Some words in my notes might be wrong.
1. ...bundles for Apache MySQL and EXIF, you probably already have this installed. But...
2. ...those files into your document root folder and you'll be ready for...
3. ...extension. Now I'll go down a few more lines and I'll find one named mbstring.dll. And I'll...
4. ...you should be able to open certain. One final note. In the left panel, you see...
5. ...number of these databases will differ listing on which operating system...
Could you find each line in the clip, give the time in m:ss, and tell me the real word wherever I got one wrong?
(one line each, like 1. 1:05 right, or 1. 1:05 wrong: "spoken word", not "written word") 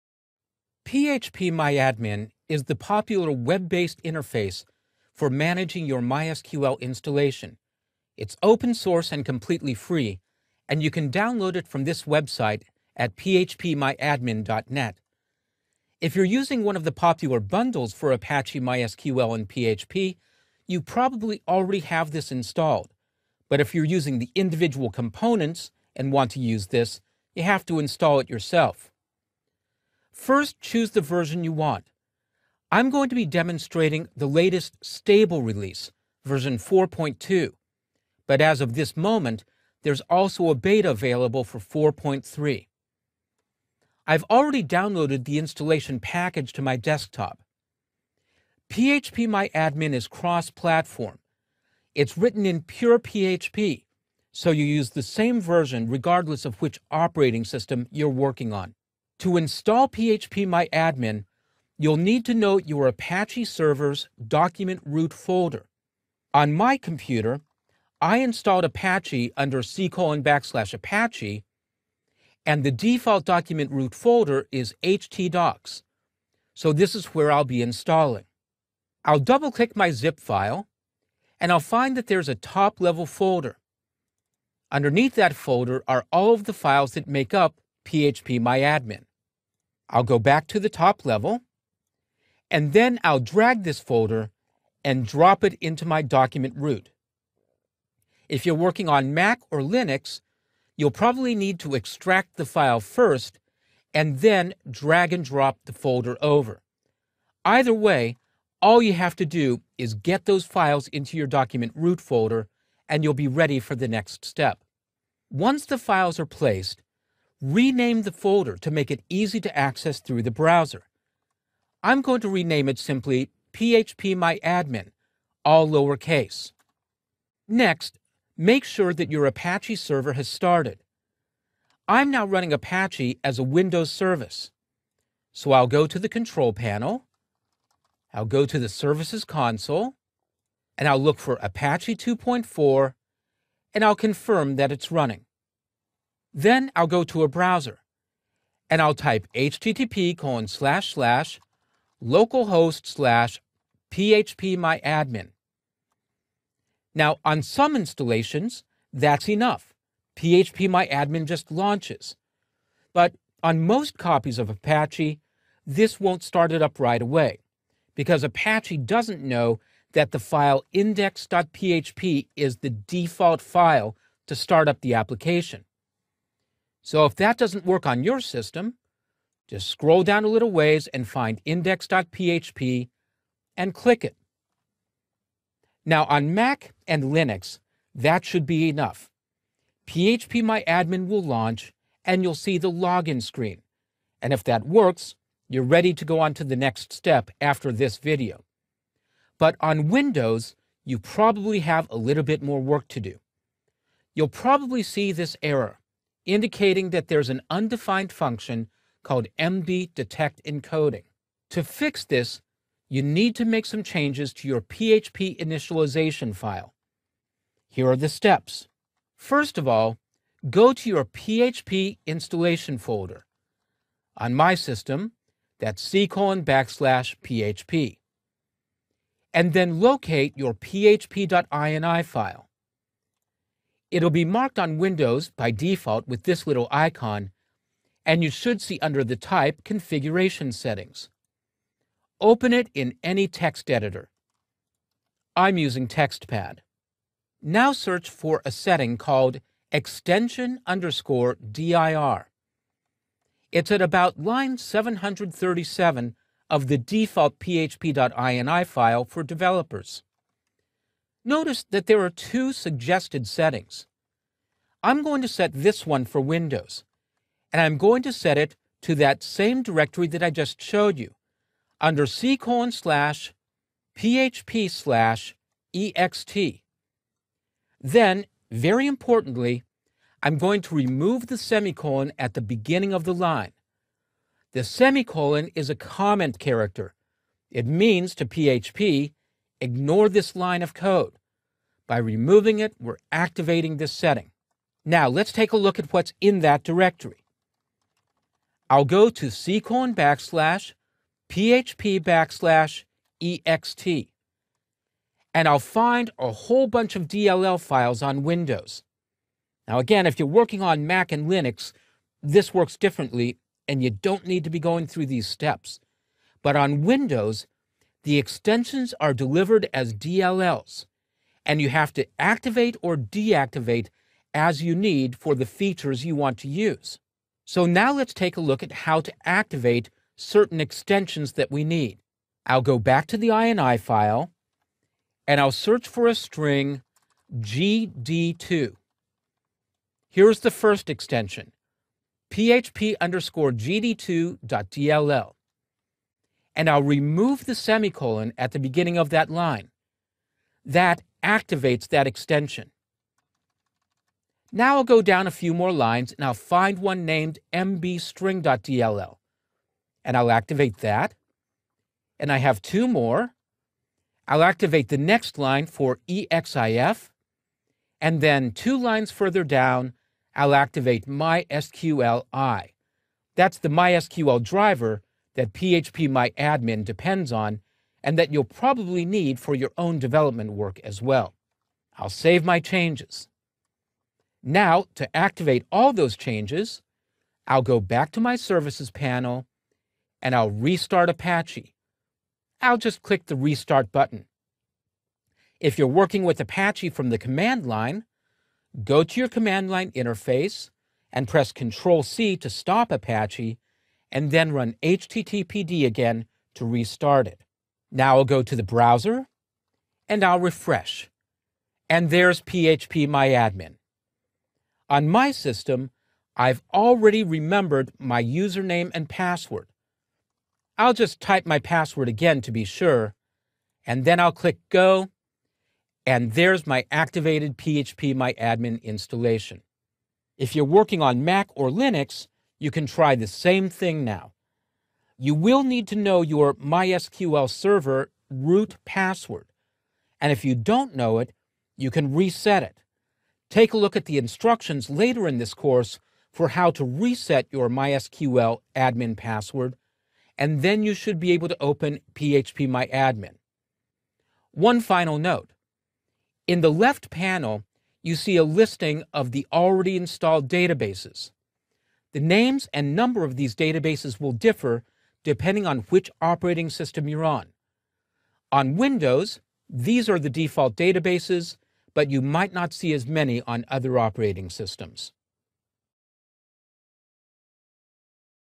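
1. 0:17 wrong: "PHP", not "EXIF"
2. 1:50 right
3. 5:52 right
4. 7:30 wrong: "phpMyAdmin", not "certain"
5. 7:42 wrong: "depending", not "listing".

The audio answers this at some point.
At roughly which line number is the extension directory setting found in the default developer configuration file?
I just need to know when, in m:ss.
4:14.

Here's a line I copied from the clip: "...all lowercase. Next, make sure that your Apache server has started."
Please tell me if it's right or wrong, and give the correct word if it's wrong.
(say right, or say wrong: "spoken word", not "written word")
right.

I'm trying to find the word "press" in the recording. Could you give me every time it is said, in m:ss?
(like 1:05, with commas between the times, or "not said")
6:41.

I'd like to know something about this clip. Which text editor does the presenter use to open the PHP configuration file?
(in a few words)
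TextPad.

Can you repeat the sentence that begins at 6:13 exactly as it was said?
That's the MySQL driver that PHP MyAdmin depends on and that you'll probably need for your own development work as well.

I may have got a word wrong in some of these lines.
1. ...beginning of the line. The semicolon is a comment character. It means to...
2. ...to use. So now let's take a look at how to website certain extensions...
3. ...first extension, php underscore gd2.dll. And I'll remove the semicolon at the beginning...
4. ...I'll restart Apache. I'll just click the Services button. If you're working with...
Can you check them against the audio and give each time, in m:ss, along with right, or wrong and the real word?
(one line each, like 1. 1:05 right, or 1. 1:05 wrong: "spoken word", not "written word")
1. 4:42 right
2. 5:26 wrong: "activate", not "website"
3. 5:40 right
4. 6:30 wrong: "Restart", not "Services".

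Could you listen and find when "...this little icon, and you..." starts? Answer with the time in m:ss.
3:56.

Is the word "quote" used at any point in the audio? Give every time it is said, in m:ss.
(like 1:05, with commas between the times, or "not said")
not said.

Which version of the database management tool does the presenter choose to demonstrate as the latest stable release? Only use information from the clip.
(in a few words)
4.2.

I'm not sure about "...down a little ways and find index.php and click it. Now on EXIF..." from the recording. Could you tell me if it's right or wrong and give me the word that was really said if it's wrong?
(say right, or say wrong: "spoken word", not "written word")
wrong: "Mac", not "EXIF".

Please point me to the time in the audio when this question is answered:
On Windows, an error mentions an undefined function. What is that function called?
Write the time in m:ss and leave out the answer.
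3:29.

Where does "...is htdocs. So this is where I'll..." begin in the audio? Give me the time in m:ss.
1:14.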